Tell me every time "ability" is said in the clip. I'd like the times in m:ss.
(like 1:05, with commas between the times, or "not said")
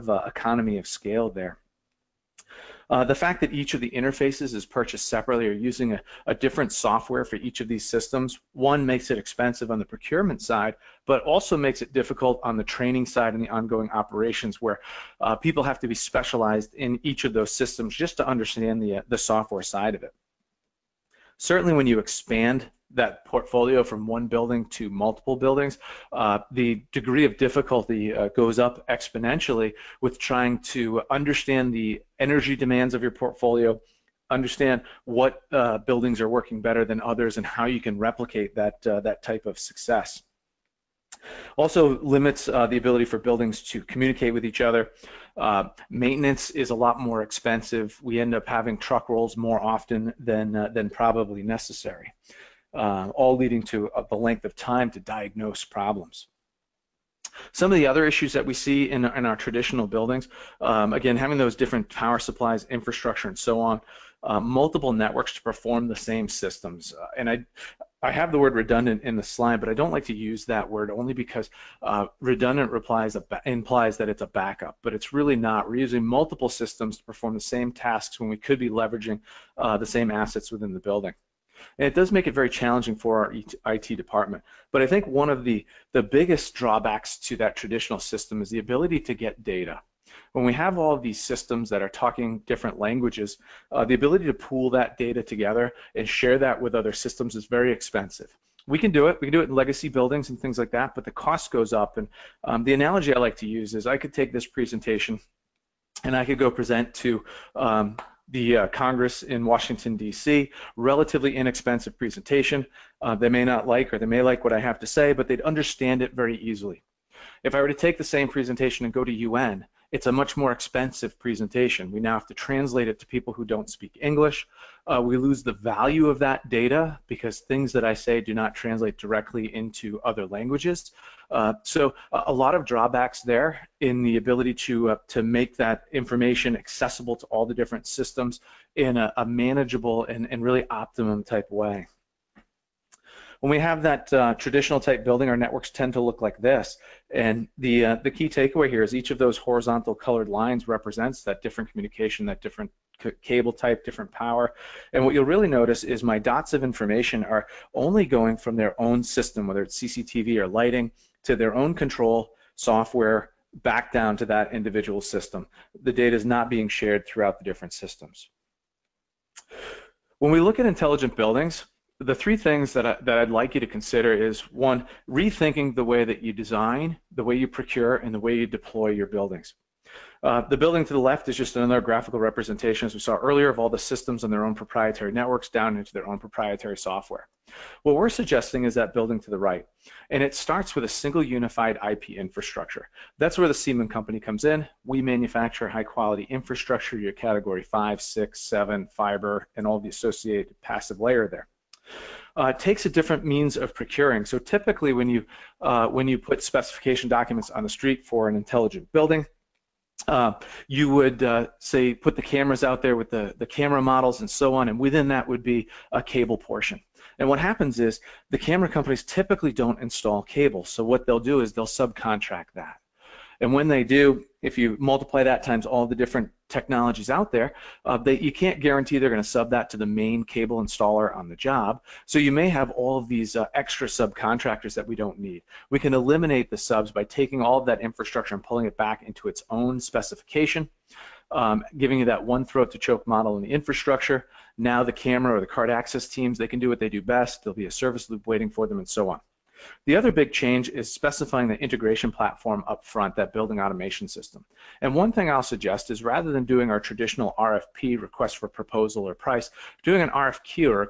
0:42, 1:28, 1:33, 2:14.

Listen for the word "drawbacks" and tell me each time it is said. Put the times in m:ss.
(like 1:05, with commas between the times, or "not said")
1:26, 2:12.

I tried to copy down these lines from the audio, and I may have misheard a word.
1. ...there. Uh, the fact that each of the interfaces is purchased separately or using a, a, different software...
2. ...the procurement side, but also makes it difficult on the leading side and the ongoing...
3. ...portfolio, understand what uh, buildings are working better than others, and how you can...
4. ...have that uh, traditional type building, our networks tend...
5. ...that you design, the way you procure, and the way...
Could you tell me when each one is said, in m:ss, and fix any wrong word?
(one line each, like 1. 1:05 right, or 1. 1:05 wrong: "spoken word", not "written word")
1. 0:01 right
2. 0:09 wrong: "training", not "leading"
3. 0:33 right
4. 2:23 right
5. 2:56 right.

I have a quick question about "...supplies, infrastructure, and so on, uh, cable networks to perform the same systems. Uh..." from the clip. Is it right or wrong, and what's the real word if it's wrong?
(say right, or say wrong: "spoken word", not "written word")
wrong: "multiple", not "cable".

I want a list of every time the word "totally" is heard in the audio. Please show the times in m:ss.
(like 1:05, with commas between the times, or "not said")
not said.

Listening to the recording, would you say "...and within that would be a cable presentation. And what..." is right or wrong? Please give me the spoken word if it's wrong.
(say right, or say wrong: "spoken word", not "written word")
wrong: "portion", not "presentation".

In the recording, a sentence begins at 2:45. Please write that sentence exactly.
The data is not being shared throughout the different systems.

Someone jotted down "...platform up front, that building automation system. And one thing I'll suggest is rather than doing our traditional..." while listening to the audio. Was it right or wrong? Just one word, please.
right.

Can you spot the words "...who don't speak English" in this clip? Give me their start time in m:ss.
2:03.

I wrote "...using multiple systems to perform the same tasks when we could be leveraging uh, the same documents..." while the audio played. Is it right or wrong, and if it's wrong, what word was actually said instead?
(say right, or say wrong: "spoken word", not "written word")
wrong: "assets", not "documents".